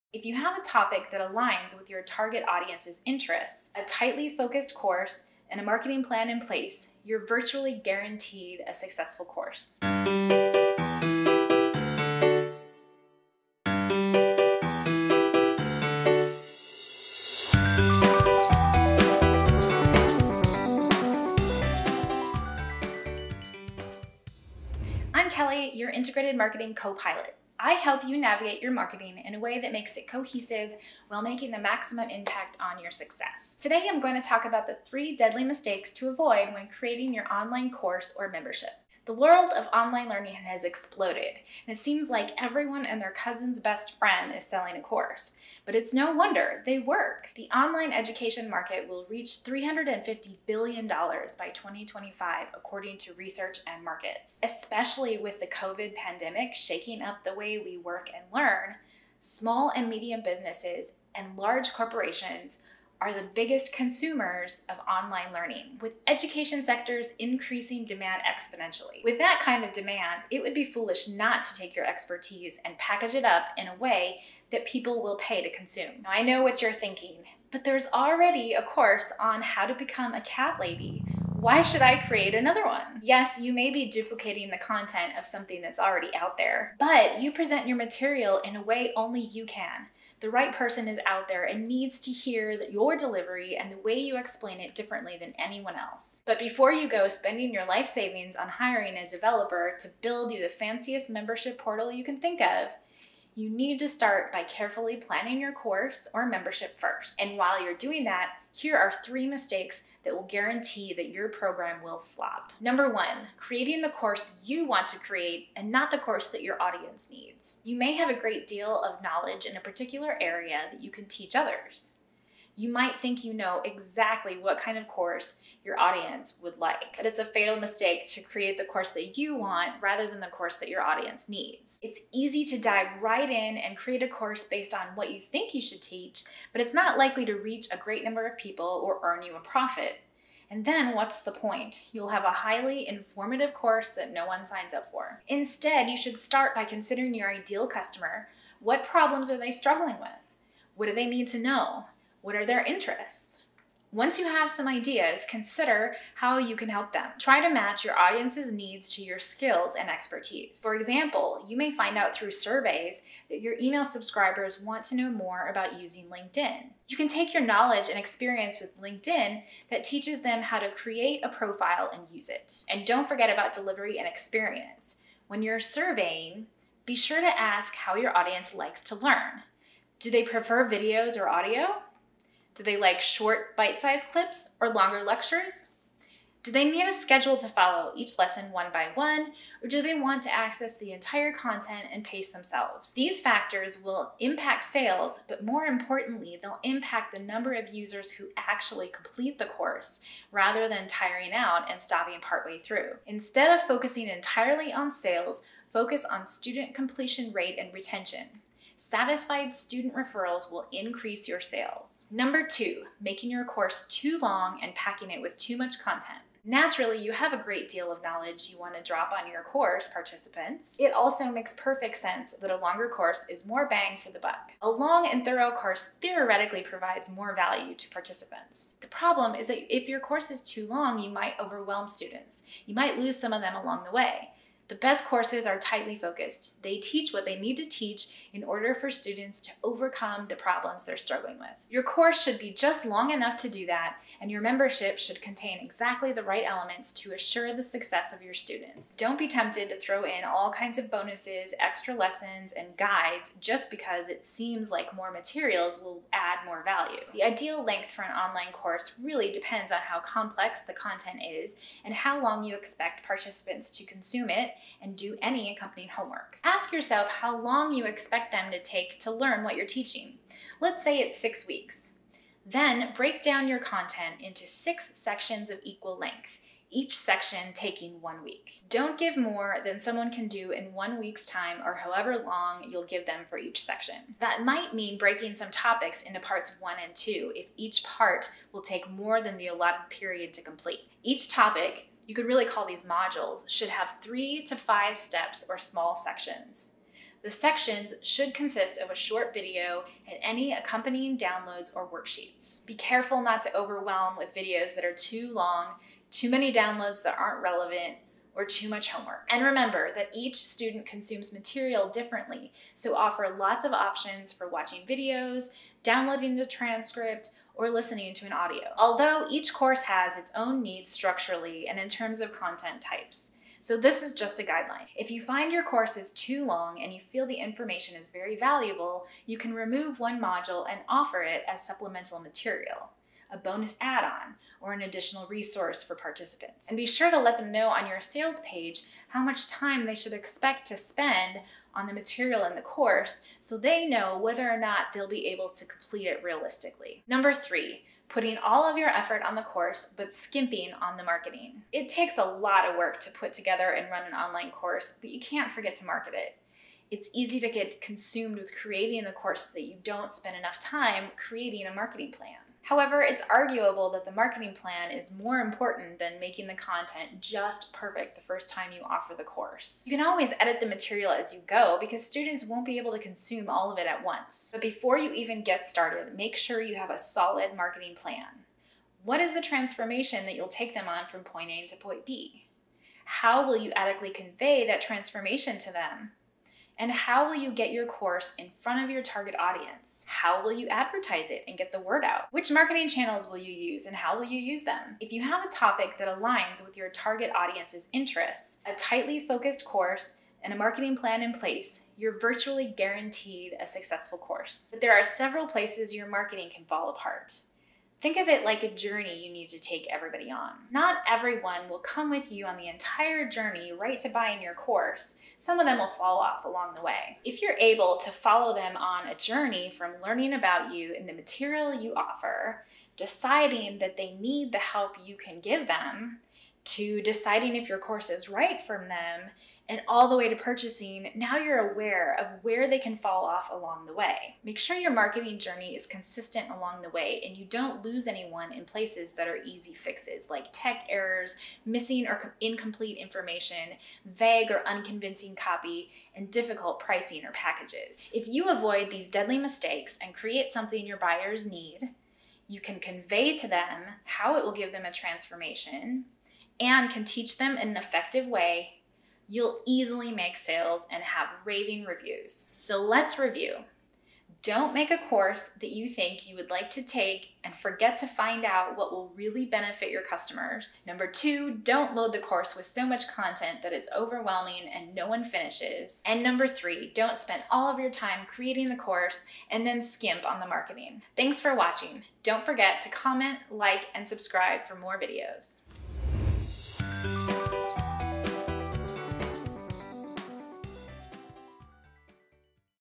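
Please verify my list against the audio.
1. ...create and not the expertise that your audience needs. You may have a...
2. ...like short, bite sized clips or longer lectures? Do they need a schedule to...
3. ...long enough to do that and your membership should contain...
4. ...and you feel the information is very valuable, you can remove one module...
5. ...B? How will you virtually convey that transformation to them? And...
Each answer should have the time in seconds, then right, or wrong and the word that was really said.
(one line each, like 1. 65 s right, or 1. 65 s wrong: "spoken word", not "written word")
1. 114 s wrong: "course", not "expertise"
2. 182 s right
3. 242 s right
4. 326 s right
5. 382 s wrong: "adequately", not "virtually".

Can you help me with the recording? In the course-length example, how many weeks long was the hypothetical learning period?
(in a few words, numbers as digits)
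6.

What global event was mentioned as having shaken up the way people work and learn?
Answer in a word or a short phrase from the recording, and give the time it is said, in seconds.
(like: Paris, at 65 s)
COVID pandemic, at 55 s.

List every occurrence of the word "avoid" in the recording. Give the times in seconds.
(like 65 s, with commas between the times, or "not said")
36 s, 448 s.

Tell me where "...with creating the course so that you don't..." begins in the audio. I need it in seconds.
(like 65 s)
358 s.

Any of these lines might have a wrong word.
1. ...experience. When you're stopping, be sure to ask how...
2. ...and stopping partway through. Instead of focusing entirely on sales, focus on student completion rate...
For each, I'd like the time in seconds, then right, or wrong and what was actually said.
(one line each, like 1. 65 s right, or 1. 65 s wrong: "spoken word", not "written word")
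1. 174 s wrong: "surveying", not "stopping"
2. 201 s right.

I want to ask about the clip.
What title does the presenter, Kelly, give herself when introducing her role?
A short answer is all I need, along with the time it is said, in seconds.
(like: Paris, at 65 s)
Integrated Marketing Co-Pilot, at 25 s.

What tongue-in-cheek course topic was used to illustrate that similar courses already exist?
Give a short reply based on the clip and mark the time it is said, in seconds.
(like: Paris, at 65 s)
how to become a cat lady, at 79 s.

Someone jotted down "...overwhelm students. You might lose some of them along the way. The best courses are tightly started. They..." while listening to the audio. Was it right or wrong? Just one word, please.
wrong.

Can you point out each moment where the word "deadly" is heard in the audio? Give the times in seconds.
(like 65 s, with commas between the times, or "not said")
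35 s, 449 s.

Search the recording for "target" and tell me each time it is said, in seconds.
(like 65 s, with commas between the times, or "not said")
2 s, 389 s, 396 s.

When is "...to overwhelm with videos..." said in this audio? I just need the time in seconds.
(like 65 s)
303 s.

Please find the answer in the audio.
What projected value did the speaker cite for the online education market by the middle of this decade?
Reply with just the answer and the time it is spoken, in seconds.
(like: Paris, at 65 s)
$350 billion, at 49 s.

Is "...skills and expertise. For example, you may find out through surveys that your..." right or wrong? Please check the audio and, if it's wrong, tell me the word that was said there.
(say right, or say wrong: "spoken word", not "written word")
right.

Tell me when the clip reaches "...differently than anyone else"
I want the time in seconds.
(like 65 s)
94 s.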